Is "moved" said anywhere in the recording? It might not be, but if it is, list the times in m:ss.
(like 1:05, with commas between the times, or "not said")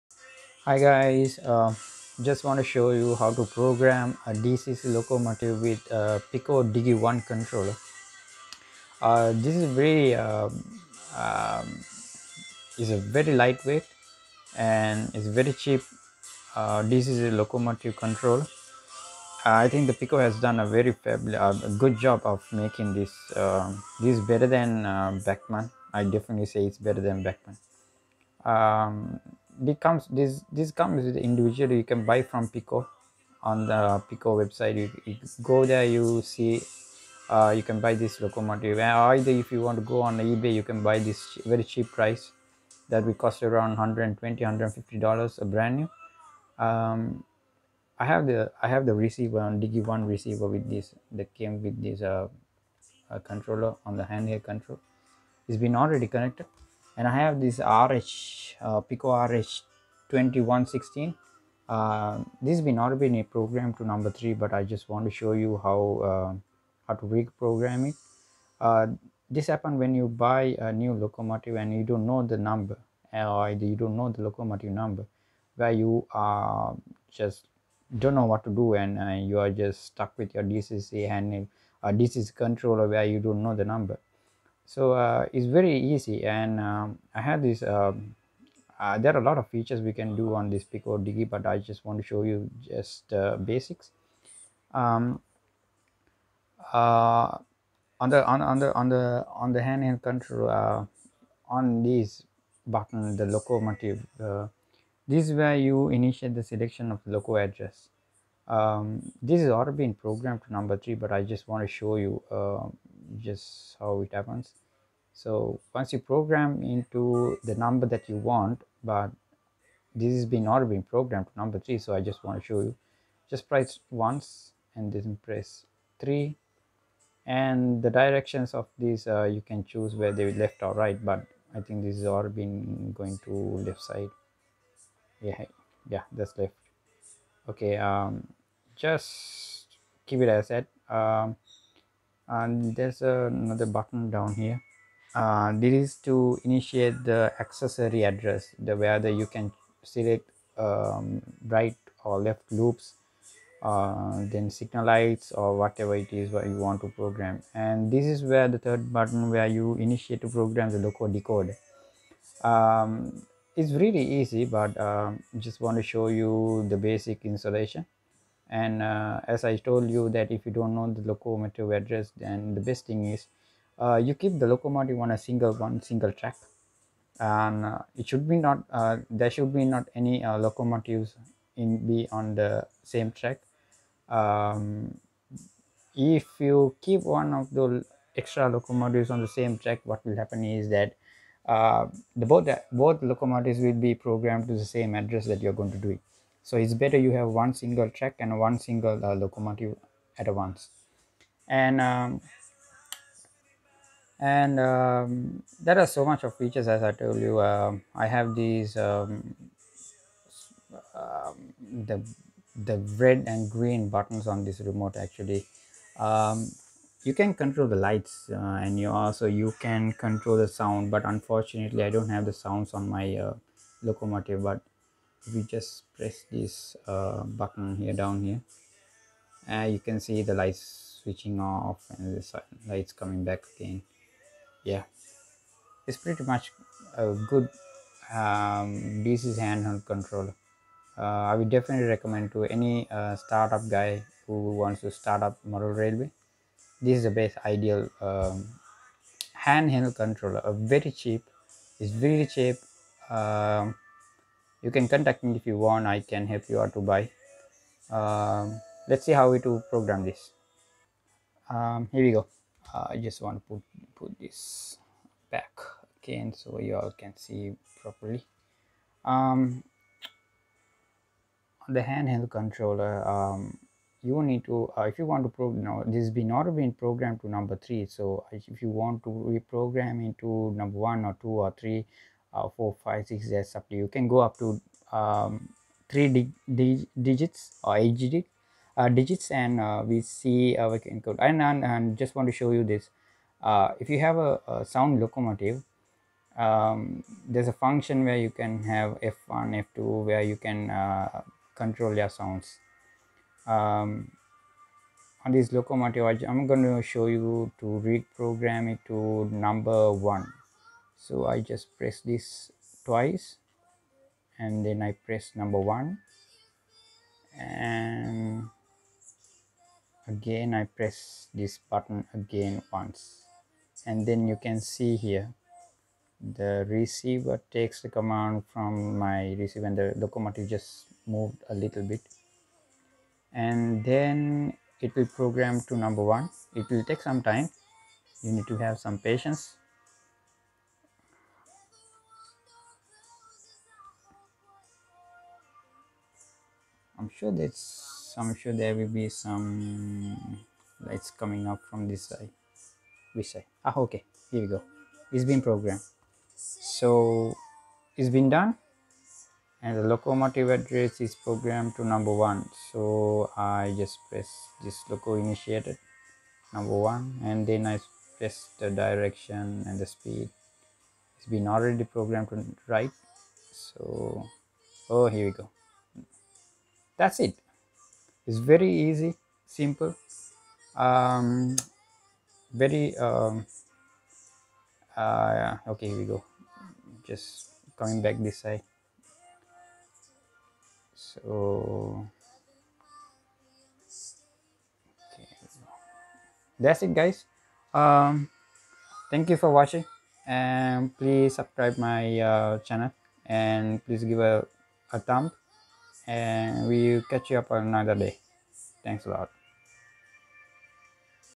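5:31.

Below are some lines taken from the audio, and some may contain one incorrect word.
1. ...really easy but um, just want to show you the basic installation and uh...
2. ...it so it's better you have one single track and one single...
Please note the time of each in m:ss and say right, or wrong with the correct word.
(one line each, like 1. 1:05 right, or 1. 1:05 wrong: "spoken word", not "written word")
1. 2:43 right
2. 3:15 right.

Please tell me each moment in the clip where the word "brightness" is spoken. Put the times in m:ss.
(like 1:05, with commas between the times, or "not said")
not said.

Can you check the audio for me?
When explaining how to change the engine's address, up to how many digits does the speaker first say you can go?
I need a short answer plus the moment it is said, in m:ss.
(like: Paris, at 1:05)
3, at 4:45.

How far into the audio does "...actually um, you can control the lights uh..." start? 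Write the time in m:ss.
3:34.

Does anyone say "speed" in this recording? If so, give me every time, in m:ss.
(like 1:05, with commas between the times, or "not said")
6:09.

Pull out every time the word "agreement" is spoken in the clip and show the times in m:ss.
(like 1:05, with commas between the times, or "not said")
not said.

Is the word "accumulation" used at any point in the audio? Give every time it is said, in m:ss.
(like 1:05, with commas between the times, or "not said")
not said.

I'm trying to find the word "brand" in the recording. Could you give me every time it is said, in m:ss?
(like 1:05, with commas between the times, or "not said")
0:45.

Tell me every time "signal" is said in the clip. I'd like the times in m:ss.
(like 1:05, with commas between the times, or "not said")
2:34.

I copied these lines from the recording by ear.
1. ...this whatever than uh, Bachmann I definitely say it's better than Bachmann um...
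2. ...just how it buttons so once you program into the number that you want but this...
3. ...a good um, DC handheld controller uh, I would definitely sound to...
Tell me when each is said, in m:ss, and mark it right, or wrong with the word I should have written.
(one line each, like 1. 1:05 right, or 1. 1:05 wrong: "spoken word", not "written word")
1. 0:23 wrong: "better", not "whatever"
2. 1:53 wrong: "happens", not "buttons"
3. 3:56 wrong: "recommend", not "sound".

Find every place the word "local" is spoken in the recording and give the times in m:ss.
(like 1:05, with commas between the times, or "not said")
1:47, 2:40.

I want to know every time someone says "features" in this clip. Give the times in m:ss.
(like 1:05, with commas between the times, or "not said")
1:29, 3:26.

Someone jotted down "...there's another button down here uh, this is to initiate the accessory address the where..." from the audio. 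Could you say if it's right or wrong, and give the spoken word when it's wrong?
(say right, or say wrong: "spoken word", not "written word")
right.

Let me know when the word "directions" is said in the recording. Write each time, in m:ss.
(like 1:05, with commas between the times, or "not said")
2:07, 6:08.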